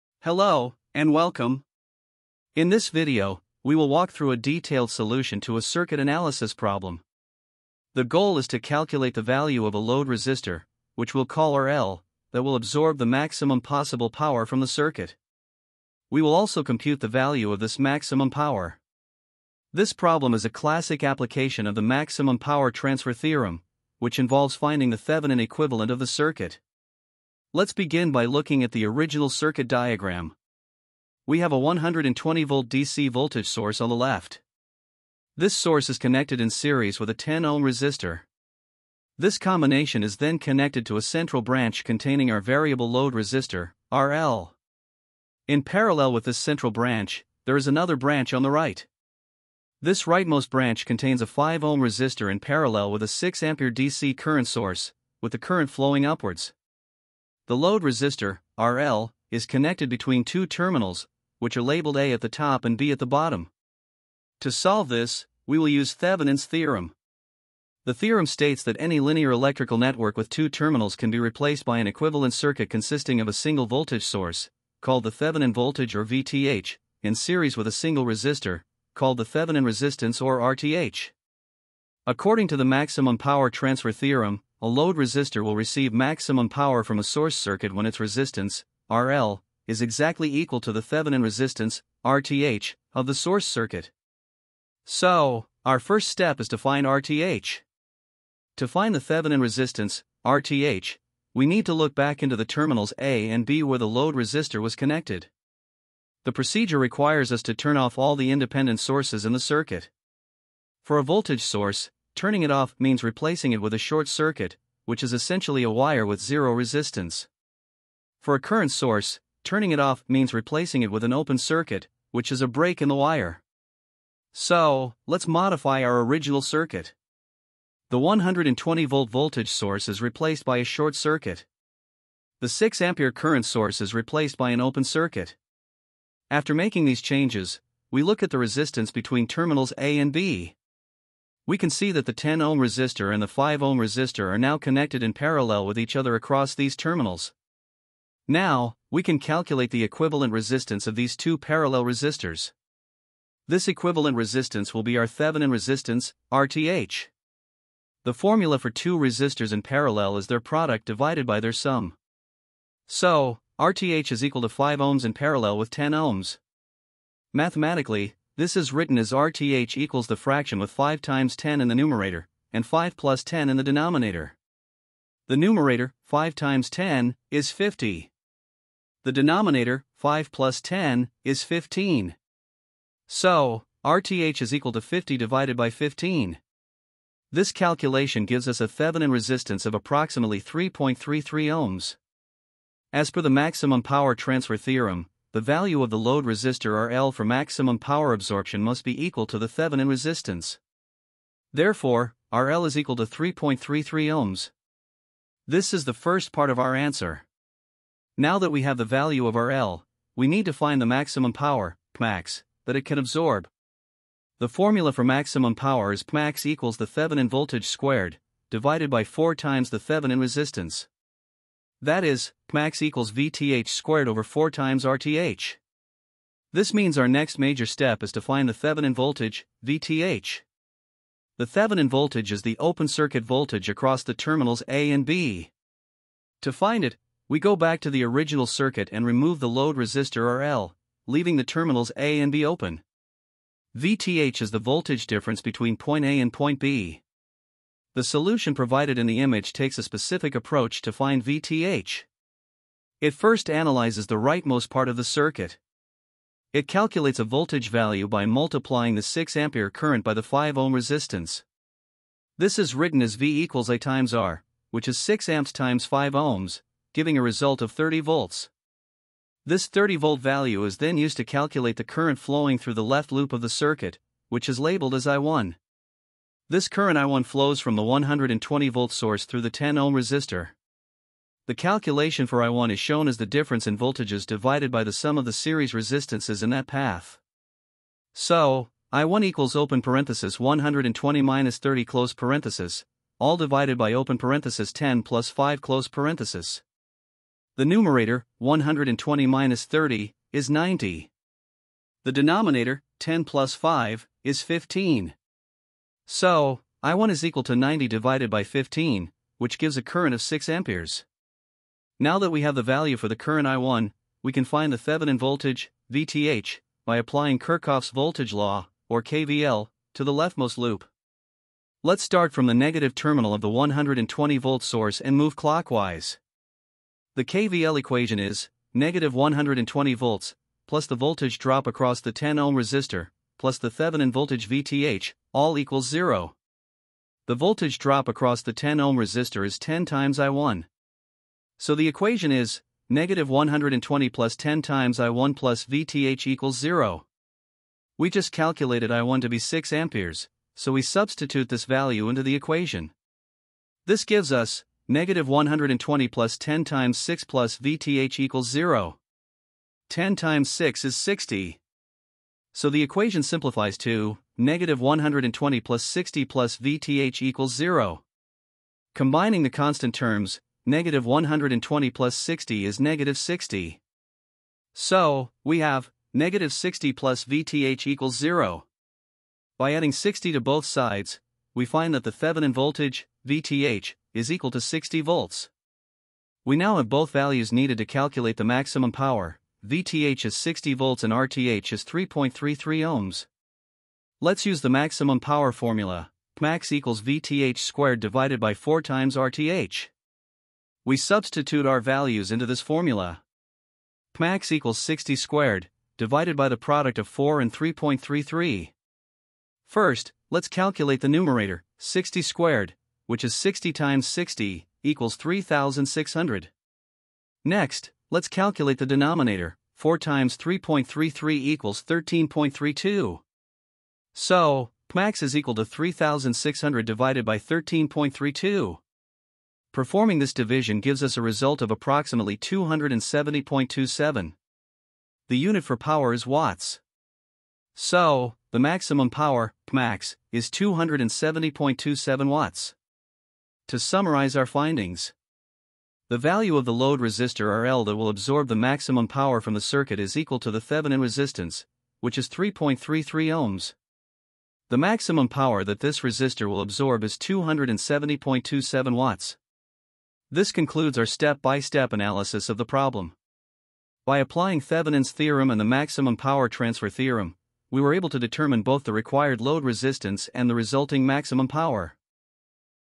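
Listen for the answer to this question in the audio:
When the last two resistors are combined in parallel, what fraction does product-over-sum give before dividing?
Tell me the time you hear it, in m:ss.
3:04.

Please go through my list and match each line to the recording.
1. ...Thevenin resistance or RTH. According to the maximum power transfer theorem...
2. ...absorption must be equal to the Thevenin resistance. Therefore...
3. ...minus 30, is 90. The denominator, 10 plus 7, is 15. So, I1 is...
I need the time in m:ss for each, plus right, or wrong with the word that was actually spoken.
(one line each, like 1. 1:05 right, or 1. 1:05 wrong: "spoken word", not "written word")
1. 1:19 right
2. 3:18 right
3. 4:59 wrong: "5", not "7".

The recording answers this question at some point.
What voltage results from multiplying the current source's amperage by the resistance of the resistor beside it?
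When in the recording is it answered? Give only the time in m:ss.
4:27.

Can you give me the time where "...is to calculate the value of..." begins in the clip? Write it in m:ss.
0:08.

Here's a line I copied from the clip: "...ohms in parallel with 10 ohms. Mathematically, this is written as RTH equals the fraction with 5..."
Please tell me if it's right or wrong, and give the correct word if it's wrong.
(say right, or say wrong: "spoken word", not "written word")
right.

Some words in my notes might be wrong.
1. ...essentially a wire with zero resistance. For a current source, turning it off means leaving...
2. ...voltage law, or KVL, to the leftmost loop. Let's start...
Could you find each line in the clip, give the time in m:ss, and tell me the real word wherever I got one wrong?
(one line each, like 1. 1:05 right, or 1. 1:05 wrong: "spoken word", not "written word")
1. 1:55 wrong: "replacing", not "leaving"
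2. 5:17 right.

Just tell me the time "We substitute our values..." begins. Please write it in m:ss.
6:40.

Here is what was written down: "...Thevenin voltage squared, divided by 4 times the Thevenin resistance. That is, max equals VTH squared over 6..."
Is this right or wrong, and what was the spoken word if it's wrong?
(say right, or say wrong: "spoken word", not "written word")
wrong: "4", not "6".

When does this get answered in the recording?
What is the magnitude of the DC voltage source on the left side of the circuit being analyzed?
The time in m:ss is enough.
0:31.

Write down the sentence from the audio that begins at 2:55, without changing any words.
The numerator, 5 times 10, is 50.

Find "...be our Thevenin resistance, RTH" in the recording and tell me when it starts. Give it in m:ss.
2:34.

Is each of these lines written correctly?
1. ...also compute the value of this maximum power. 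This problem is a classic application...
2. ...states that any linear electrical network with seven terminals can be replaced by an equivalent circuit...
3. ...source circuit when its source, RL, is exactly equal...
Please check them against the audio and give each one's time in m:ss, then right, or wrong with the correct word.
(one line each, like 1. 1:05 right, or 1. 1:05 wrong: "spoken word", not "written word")
1. 0:16 right
2. 1:08 wrong: "two", not "seven"
3. 1:27 wrong: "resistance", not "source".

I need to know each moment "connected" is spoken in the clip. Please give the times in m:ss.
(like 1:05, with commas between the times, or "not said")
0:35, 0:40, 0:59, 1:44, 2:24.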